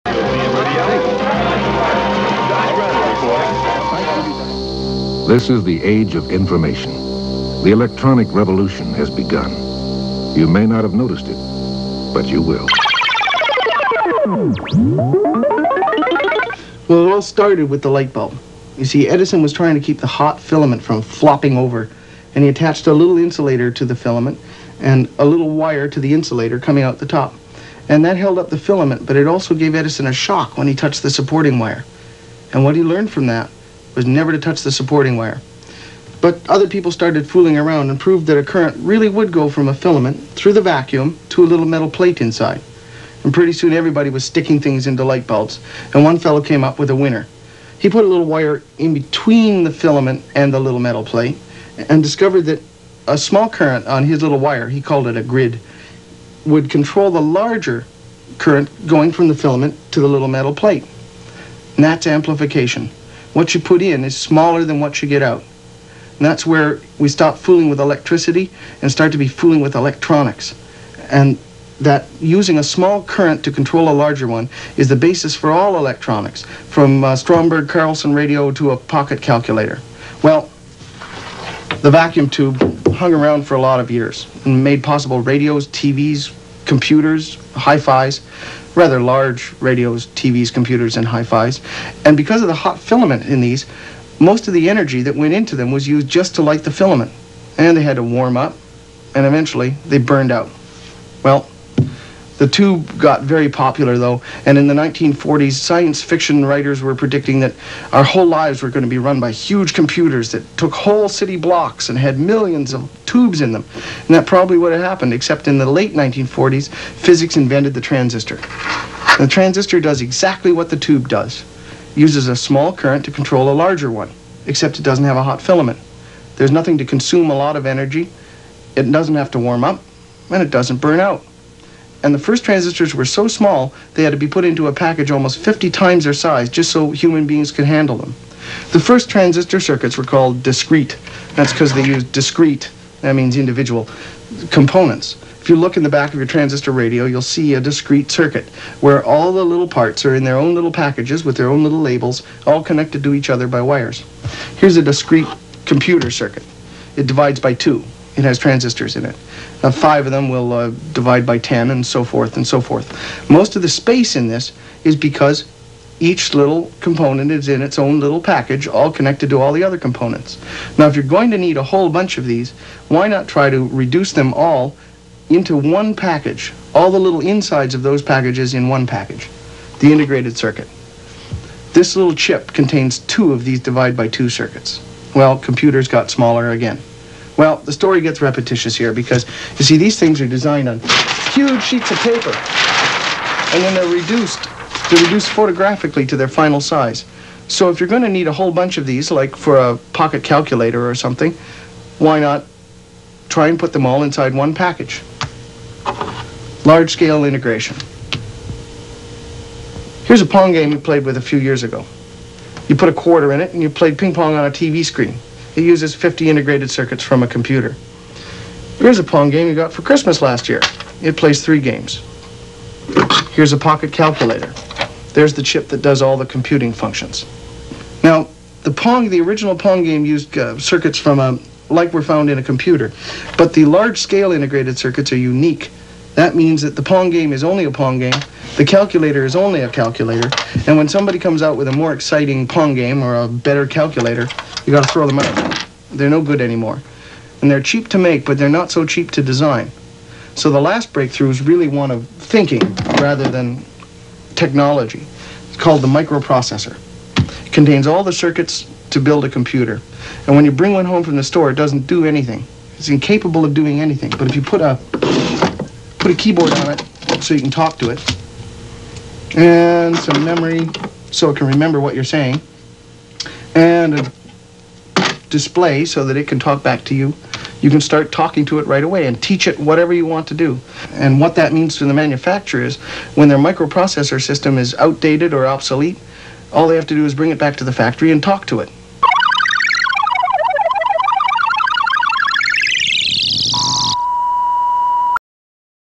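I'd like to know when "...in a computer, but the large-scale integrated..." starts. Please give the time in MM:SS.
03:52.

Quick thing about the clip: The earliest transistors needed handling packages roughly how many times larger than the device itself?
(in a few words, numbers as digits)
50.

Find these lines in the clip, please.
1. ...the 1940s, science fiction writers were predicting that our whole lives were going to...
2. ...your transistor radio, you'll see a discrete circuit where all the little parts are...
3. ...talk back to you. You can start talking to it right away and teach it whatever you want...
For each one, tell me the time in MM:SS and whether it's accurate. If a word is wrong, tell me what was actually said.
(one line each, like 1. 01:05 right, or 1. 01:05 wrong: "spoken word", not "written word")
1. 01:44 right
2. 02:26 right
3. 04:36 right.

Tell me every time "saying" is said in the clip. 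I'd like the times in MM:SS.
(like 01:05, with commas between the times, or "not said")
04:32.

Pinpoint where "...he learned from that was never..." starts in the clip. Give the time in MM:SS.
00:32.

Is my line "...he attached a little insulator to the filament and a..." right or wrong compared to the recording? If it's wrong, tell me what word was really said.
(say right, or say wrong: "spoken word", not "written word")
right.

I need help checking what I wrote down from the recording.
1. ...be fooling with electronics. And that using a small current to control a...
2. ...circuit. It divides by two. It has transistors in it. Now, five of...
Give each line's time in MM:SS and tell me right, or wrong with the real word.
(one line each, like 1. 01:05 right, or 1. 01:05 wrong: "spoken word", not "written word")
1. 01:09 right
2. 02:36 right.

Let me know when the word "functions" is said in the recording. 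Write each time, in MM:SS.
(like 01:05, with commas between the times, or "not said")
03:46.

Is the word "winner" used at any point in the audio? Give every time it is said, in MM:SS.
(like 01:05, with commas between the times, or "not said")
00:46.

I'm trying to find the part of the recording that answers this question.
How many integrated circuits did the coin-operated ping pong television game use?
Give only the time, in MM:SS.
03:35.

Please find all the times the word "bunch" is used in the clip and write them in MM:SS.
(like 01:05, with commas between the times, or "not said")
02:51, 03:18.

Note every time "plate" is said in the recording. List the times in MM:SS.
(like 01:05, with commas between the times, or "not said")
00:41, 00:51, 01:00.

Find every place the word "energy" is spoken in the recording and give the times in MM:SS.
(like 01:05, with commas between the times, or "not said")
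01:34, 02:07.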